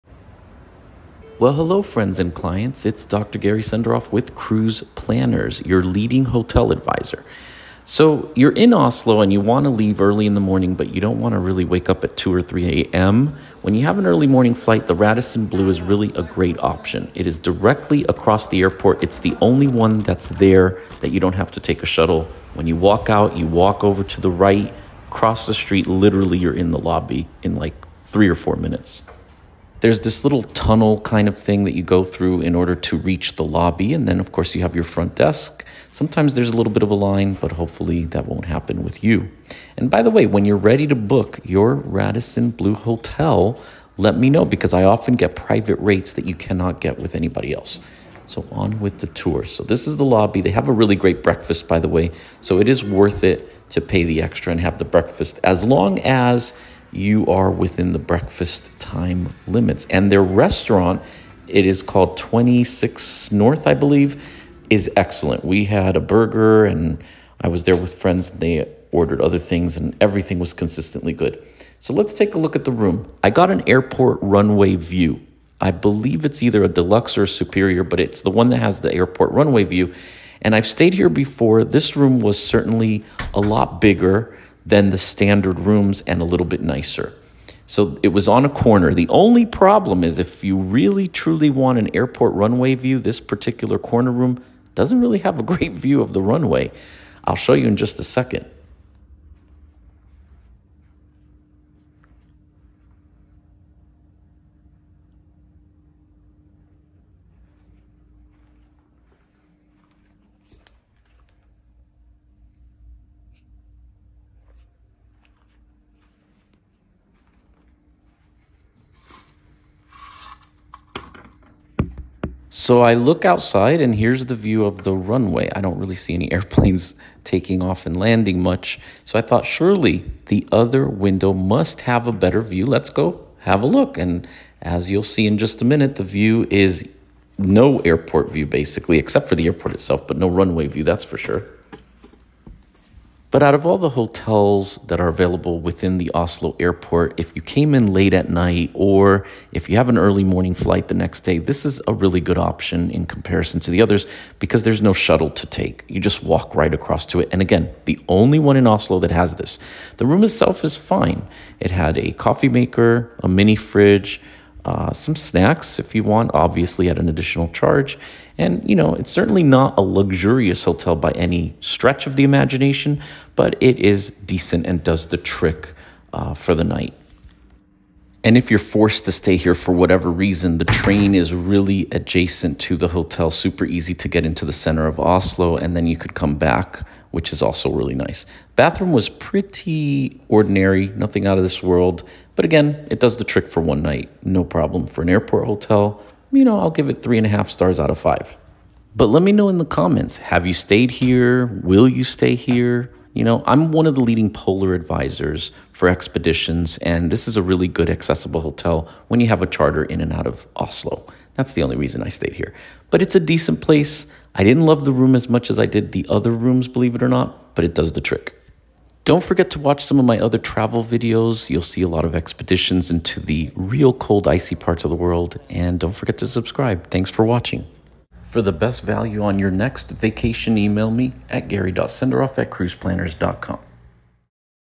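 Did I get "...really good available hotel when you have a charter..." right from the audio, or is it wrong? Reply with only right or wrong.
wrong.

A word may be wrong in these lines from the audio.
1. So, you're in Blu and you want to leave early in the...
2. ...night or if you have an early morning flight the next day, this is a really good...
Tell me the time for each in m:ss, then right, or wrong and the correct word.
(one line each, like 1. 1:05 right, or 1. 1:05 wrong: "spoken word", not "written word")
1. 0:07 wrong: "Oslo", not "Blu"
2. 2:28 right.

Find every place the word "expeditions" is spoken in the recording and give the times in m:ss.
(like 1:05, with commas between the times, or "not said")
3:25, 3:42.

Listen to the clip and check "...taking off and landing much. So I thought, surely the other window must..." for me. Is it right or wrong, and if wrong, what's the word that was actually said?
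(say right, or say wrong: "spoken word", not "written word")
right.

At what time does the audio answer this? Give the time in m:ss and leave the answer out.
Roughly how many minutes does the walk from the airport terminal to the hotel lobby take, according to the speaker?
0:28.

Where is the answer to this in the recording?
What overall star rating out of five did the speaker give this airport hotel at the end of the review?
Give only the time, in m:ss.
3:17.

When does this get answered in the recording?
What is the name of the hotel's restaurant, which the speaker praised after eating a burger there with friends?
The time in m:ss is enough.
1:02.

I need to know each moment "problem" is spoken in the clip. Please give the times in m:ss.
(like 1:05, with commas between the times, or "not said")
1:29, 3:14.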